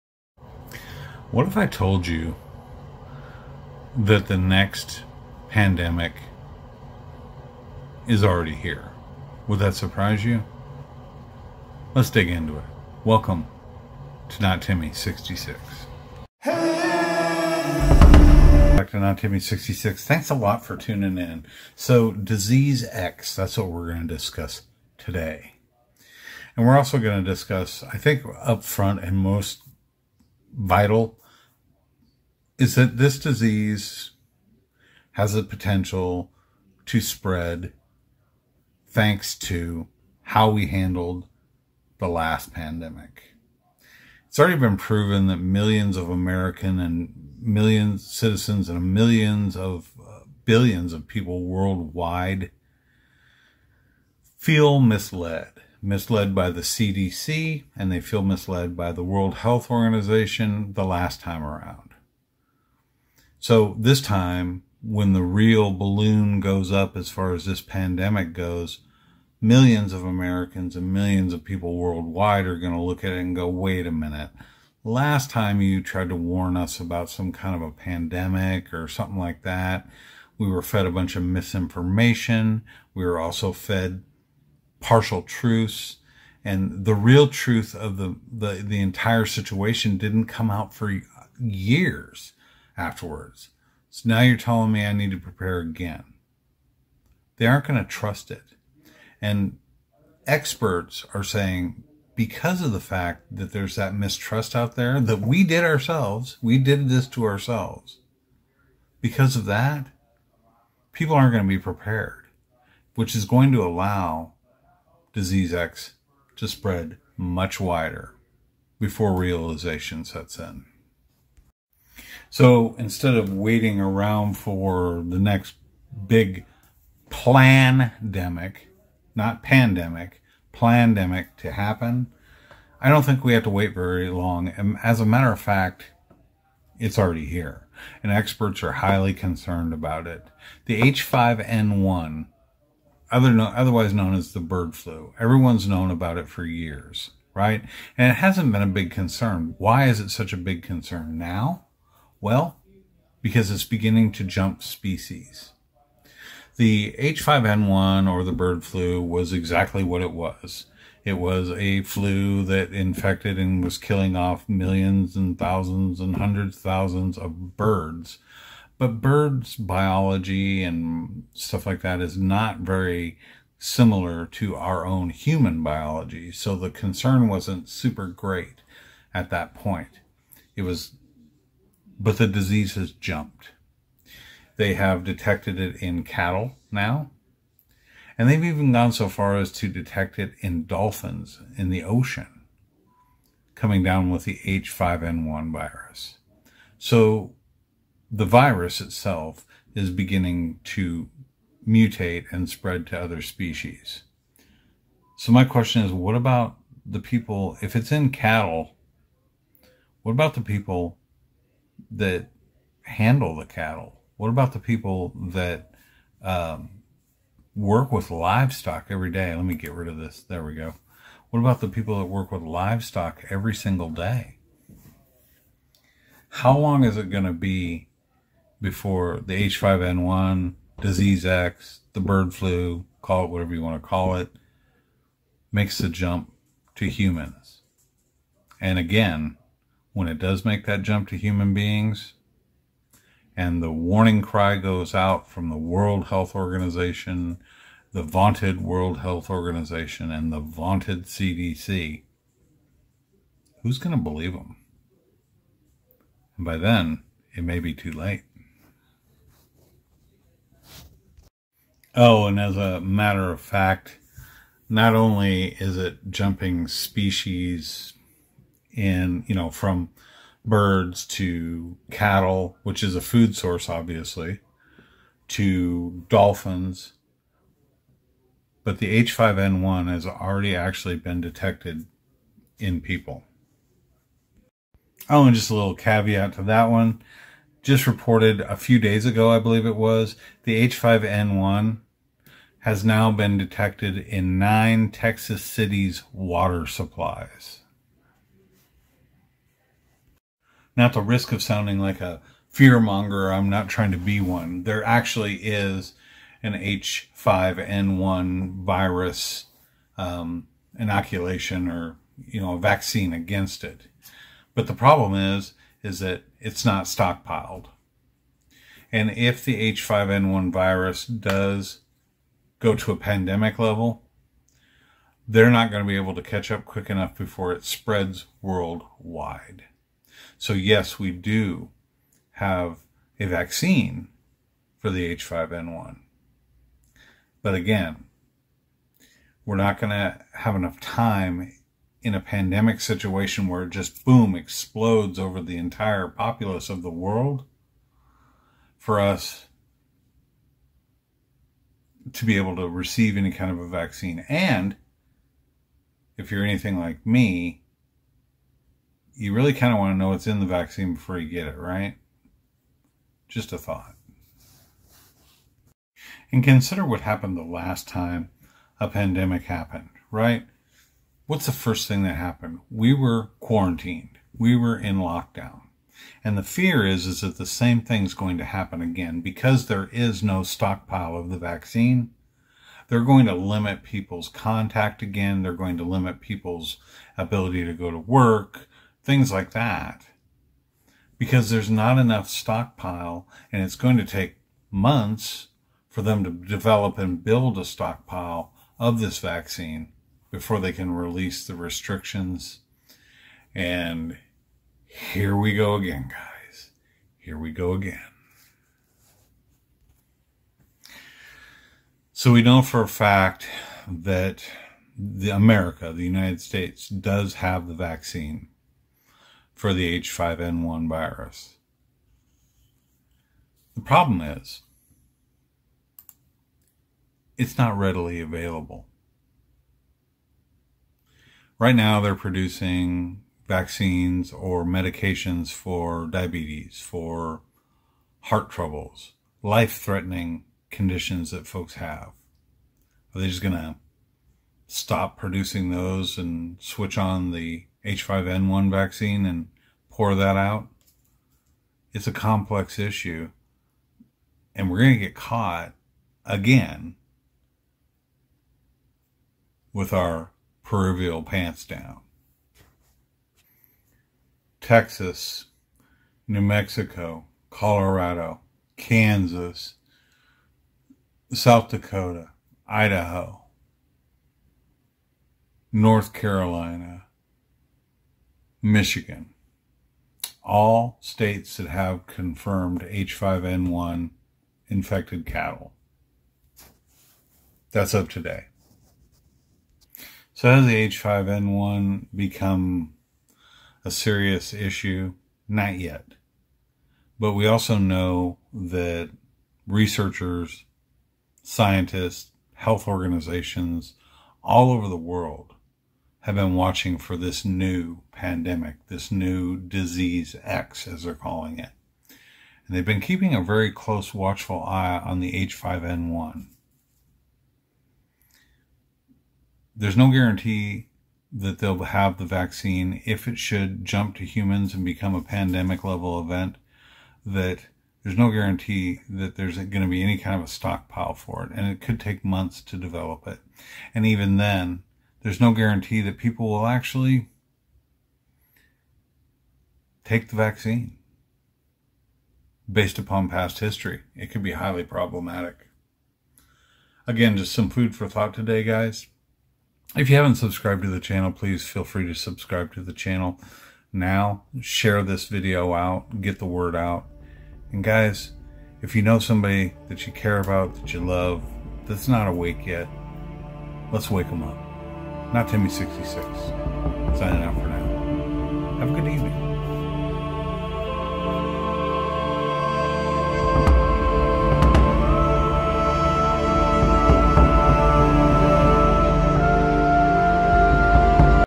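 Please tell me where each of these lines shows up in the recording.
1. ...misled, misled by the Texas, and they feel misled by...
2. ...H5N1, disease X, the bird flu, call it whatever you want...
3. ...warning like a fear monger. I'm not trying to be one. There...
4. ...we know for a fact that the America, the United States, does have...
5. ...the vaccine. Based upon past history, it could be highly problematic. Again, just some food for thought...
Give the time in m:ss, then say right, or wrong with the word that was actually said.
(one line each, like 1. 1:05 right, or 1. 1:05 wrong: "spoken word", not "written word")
1. 0:54 wrong: "CDC", not "Texas"
2. 3:49 right
3. 5:01 wrong: "sounding", not "warning"
4. 6:52 right
5. 9:00 right.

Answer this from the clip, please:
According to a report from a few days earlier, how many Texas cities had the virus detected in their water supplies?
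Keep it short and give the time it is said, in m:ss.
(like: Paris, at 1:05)
9, at 4:54.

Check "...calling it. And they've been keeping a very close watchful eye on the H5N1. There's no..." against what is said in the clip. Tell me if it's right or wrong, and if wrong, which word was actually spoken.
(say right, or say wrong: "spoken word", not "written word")
right.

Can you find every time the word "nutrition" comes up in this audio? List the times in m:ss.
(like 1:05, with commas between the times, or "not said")
not said.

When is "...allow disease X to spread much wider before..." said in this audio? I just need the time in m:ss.
1:53.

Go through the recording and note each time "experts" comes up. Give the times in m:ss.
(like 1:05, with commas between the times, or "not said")
1:40, 2:18.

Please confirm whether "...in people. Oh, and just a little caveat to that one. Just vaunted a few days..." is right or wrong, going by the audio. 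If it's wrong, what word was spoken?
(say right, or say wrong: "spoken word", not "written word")
wrong: "reported", not "vaunted".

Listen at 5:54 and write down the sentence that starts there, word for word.
And if you're anything like me, you really kind of want to know what's in the vaccine before you get it, right?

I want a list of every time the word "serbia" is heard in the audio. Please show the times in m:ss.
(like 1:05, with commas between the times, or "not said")
not said.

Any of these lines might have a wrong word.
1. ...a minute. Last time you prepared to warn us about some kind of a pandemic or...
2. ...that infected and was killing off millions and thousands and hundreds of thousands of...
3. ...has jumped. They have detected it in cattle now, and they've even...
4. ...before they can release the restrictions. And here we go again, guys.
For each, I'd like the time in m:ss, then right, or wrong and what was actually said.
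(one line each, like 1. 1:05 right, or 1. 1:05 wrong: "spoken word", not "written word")
1. 1:13 wrong: "tried", not "prepared"
2. 2:42 right
3. 3:02 right
4. 6:40 right.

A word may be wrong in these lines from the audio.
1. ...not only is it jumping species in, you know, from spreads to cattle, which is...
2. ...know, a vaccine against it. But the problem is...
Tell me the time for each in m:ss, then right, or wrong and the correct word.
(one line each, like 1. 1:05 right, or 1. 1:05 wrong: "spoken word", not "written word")
1. 4:24 wrong: "birds", not "spreads"
2. 5:12 right.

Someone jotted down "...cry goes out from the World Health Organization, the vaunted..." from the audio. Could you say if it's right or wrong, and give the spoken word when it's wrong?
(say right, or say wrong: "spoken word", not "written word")
right.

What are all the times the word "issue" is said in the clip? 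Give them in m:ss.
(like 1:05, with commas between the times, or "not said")
7:32, 8:14.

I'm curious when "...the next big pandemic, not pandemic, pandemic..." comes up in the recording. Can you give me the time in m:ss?
2:05.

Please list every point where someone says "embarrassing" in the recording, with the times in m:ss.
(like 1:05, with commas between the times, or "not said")
not said.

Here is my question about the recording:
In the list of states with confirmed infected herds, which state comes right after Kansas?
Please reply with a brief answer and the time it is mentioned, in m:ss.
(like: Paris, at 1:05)
South Dakota, at 7:51.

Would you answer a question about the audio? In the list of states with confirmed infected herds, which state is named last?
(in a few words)
Michigan.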